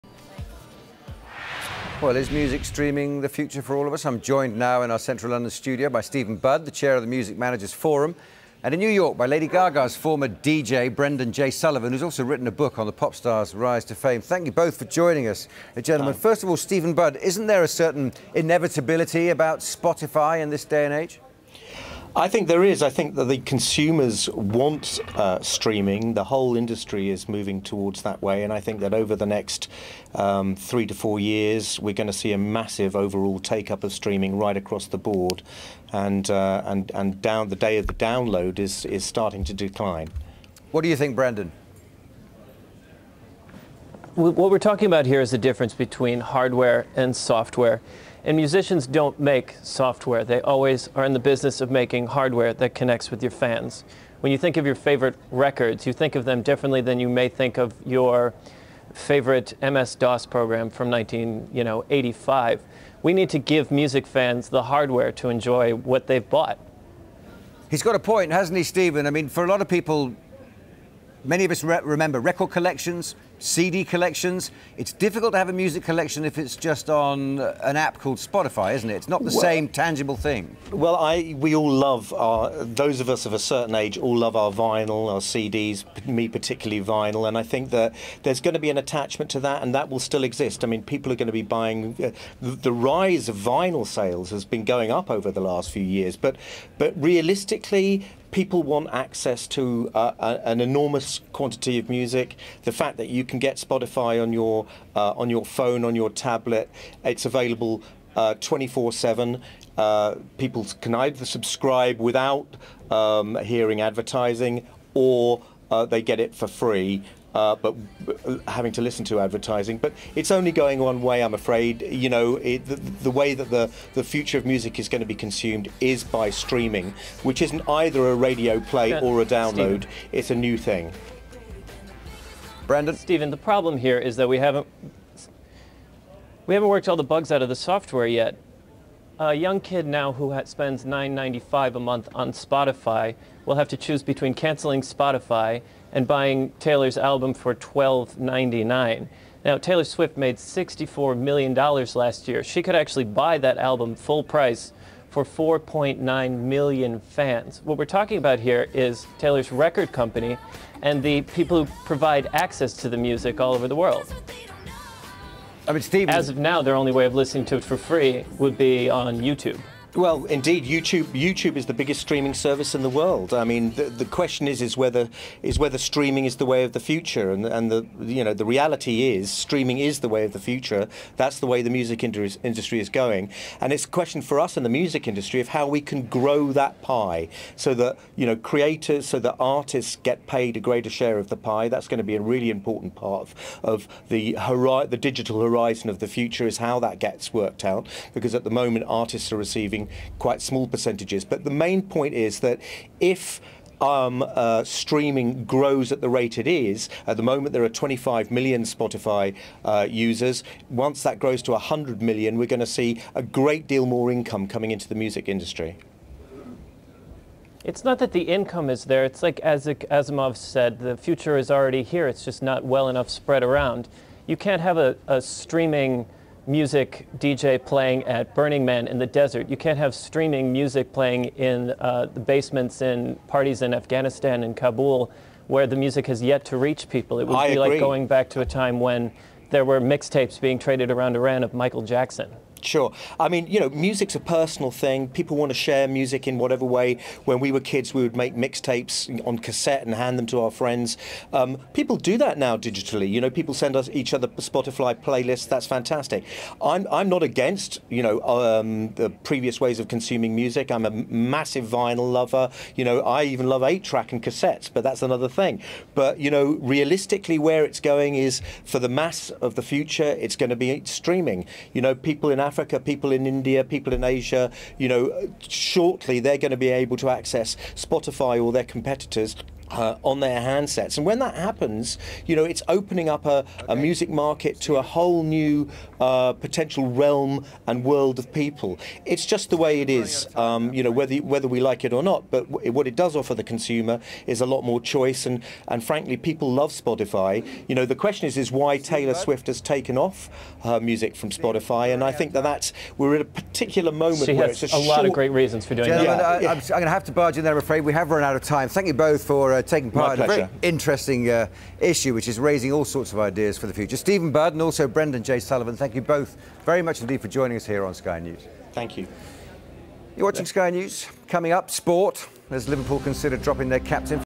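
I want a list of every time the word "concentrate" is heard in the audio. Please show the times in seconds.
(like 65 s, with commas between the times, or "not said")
not said.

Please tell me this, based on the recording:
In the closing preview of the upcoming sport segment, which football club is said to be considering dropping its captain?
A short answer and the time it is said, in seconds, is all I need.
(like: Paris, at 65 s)
Liverpool, at 322 s.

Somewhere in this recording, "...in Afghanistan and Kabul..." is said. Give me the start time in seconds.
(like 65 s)
233 s.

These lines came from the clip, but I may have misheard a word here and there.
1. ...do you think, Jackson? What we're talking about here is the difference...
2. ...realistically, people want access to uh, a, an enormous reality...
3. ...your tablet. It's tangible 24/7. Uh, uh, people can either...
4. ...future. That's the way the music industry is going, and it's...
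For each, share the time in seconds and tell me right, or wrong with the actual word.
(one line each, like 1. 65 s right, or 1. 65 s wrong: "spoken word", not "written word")
1. 40 s wrong: "Brendan", not "Jackson"
2. 97 s wrong: "quantity", not "reality"
3. 105 s wrong: "available", not "tangible"
4. 180 s right.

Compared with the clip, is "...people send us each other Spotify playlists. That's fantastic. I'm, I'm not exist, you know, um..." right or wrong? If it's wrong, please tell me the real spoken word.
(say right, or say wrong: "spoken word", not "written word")
wrong: "against", not "exist".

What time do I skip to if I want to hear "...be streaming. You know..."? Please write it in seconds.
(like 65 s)
270 s.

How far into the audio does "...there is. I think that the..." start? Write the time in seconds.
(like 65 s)
22 s.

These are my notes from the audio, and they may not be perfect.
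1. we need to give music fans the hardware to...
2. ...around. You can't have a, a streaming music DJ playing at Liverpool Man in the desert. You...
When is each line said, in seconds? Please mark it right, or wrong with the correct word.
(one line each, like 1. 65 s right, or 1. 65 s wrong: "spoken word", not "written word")
1. 63 s right
2. 223 s wrong: "Burning", not "Liverpool".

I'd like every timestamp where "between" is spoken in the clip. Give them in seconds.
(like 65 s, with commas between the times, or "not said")
45 s, 144 s.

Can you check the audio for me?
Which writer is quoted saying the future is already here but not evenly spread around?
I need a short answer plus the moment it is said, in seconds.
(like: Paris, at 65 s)
Asimov, at 219 s.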